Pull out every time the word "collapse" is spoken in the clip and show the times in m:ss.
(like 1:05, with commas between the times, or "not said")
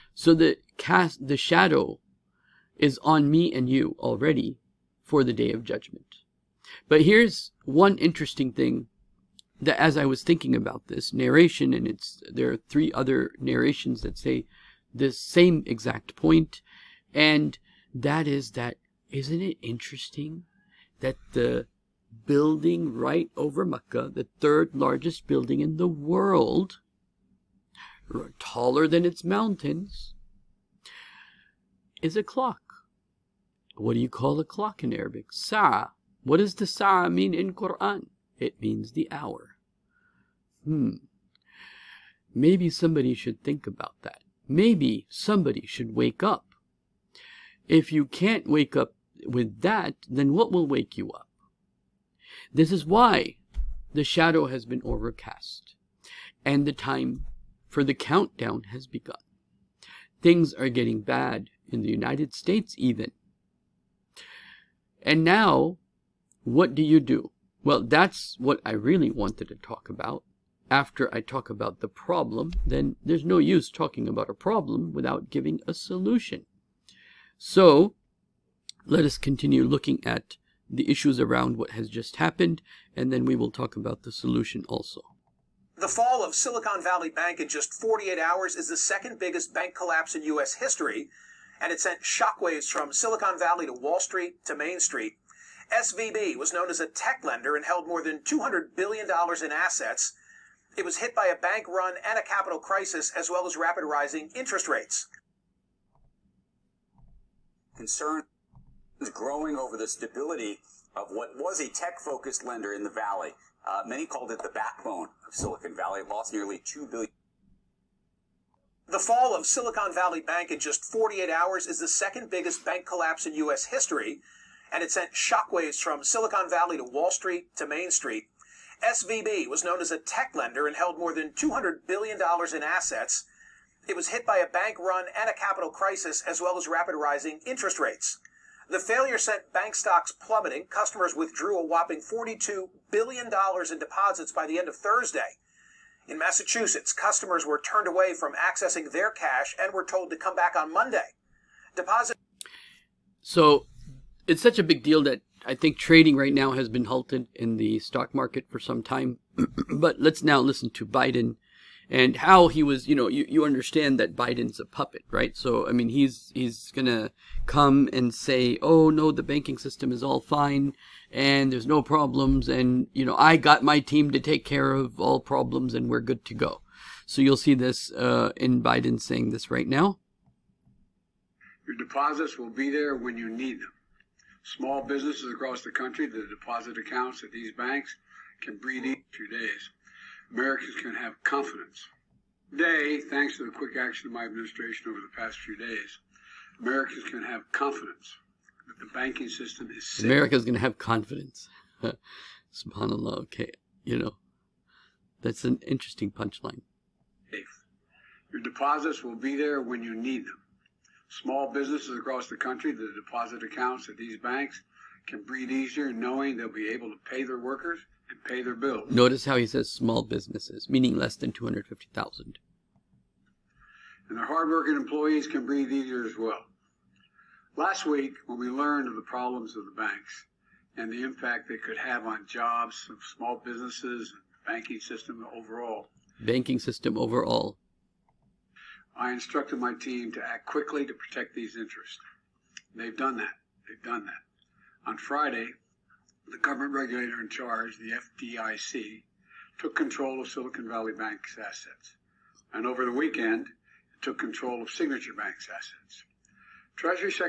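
1:29, 2:02.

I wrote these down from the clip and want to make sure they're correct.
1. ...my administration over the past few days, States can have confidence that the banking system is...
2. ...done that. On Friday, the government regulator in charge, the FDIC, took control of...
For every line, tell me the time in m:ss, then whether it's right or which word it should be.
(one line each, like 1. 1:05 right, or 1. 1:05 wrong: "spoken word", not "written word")
1. 3:14 wrong: "Americans", not "States"
2. 4:03 right.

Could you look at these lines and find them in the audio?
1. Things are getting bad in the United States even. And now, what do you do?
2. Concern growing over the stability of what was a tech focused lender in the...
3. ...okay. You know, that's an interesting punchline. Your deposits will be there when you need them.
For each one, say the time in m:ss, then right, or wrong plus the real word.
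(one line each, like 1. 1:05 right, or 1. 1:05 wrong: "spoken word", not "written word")
1. 1:00 right
2. 1:47 right
3. 3:23 right.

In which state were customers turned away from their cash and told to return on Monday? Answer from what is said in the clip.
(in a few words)
Massachusetts.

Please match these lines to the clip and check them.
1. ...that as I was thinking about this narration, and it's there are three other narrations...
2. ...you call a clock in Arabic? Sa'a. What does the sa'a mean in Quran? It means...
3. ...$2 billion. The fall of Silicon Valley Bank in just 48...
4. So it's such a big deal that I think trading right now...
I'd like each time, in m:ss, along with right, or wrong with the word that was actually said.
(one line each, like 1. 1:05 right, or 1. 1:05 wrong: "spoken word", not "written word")
1. 0:09 right
2. 0:33 right
3. 1:56 right
4. 2:33 right.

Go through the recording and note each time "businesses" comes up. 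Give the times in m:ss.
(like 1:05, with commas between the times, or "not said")
3:04, 3:31, 3:40, 3:53.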